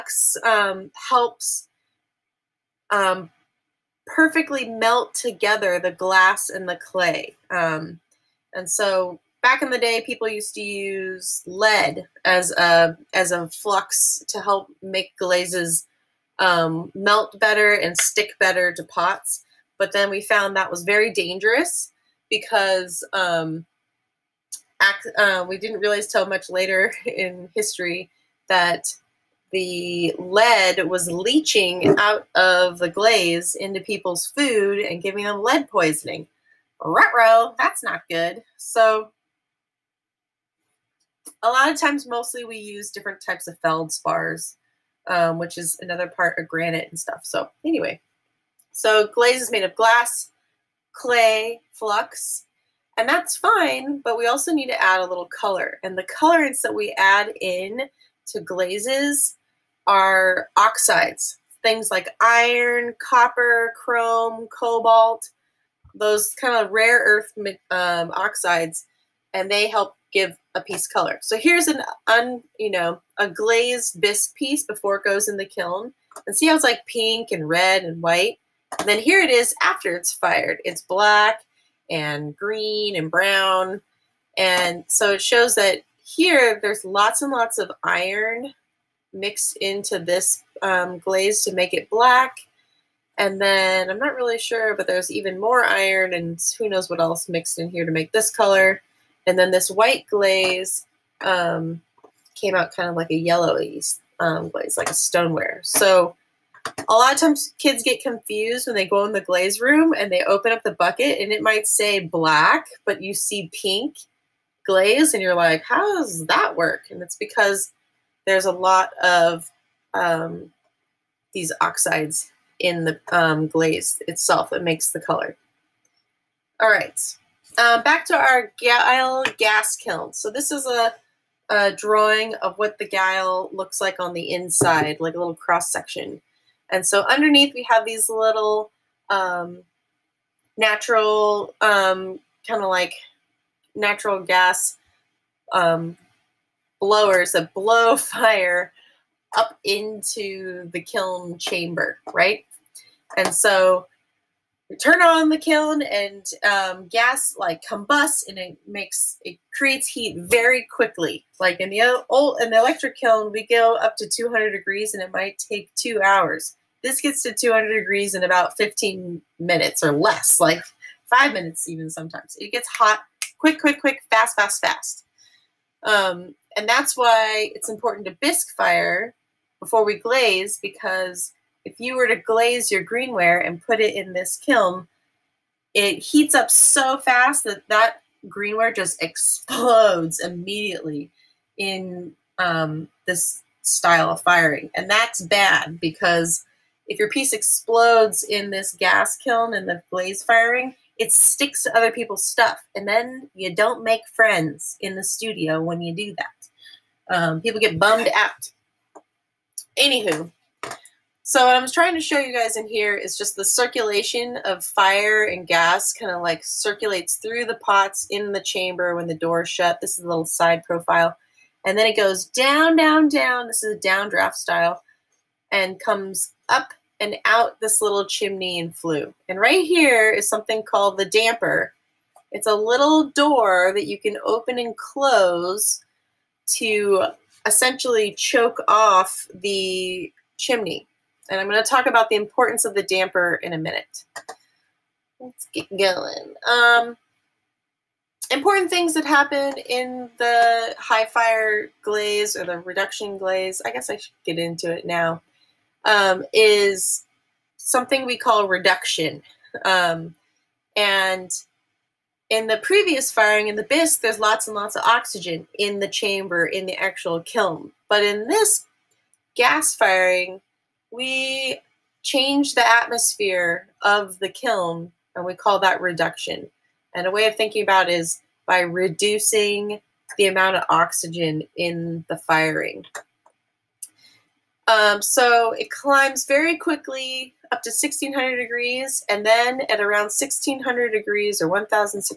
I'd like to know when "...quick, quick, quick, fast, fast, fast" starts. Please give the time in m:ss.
2:53.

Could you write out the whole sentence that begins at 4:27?
But in this gas firing, we change the atmosphere of the kiln, and we call that reduction.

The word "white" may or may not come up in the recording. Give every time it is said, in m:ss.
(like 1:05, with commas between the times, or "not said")
1:18, 1:39.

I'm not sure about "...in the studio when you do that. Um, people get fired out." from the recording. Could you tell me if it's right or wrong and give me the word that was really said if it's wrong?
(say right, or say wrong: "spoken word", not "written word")
wrong: "bummed", not "fired".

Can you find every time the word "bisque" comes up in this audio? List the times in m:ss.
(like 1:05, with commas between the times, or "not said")
1:14, 2:58, 4:23.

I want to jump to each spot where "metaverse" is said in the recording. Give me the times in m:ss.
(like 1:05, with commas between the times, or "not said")
not said.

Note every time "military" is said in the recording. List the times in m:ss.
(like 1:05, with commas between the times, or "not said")
not said.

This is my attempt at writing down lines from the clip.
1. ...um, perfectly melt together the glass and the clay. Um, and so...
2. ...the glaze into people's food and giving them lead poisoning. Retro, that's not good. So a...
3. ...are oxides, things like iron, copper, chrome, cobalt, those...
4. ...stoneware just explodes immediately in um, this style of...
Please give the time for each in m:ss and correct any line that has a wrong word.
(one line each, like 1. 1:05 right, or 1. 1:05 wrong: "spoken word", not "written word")
1. 0:02 right
2. 0:32 right
3. 0:59 right
4. 3:08 wrong: "greenware", not "stoneware".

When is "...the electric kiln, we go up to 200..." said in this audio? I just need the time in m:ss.
2:42.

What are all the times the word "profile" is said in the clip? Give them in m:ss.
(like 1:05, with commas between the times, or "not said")
3:40.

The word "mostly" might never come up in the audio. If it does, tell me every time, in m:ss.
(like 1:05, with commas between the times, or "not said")
0:42.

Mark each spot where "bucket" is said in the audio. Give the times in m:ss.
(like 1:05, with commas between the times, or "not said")
1:50.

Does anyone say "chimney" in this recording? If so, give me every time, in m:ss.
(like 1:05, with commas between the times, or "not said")
3:48, 4:00.